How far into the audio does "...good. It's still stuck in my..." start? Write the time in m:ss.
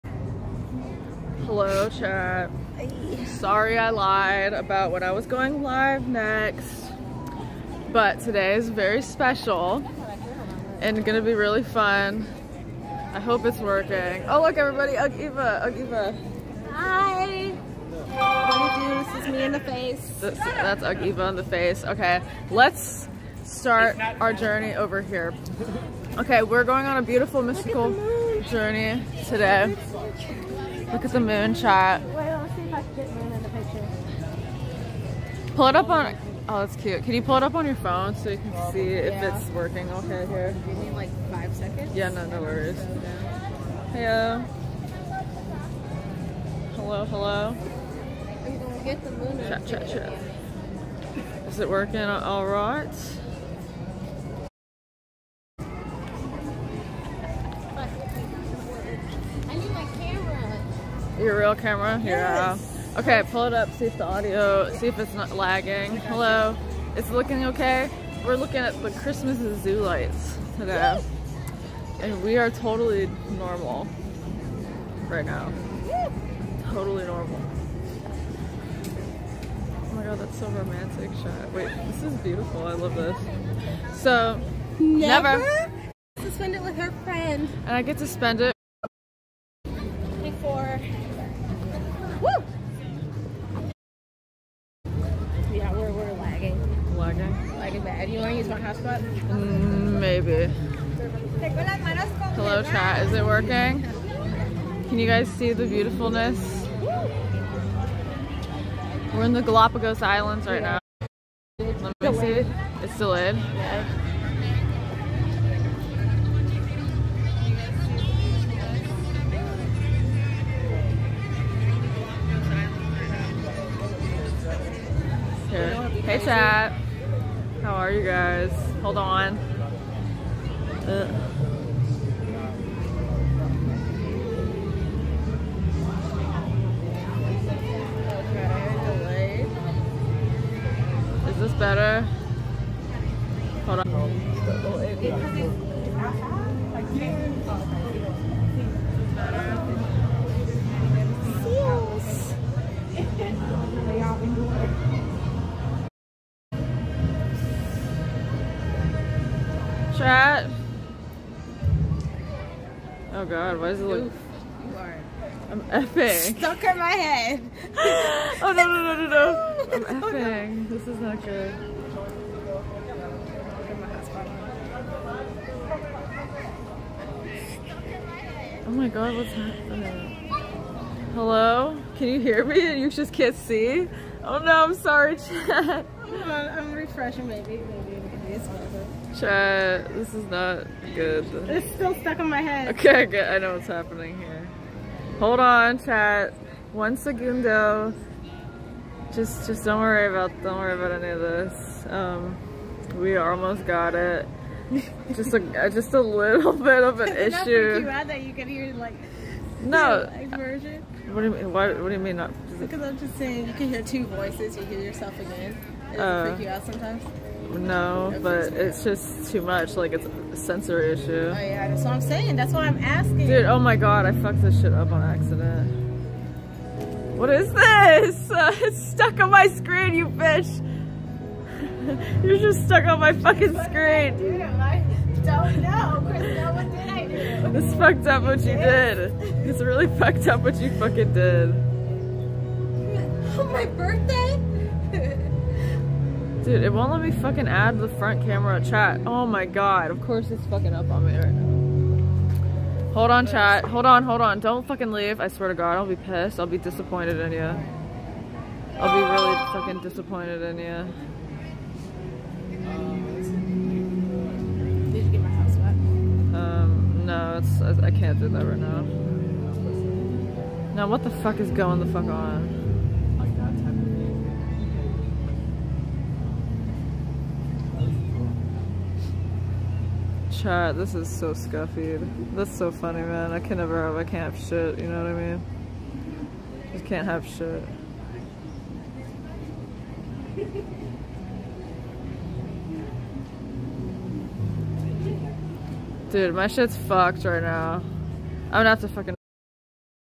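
3:10.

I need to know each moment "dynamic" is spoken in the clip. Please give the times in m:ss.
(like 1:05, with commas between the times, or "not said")
not said.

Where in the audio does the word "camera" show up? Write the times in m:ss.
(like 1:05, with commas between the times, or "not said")
1:01, 4:08.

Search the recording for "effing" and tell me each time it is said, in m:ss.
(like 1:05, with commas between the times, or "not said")
2:45, 2:50.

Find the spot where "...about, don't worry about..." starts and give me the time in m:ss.
3:20.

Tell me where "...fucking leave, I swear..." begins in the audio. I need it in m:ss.
4:14.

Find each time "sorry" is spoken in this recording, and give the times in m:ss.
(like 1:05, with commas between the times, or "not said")
0:03, 3:04.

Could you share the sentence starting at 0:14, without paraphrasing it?
Oh, look, everybody, Ug Eva, Ug Eva.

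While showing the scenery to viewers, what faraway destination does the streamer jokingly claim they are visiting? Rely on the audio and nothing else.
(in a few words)
Galapagos Islands.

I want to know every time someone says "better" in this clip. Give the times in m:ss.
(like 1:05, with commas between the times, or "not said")
2:21, 2:29.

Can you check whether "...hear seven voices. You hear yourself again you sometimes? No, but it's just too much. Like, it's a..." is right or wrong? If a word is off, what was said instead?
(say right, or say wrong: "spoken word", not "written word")
wrong: "two", not "seven".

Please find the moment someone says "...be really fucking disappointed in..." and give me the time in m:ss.
4:18.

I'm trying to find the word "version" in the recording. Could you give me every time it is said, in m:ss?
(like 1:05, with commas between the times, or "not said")
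3:30.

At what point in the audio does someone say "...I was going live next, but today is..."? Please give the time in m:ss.
0:05.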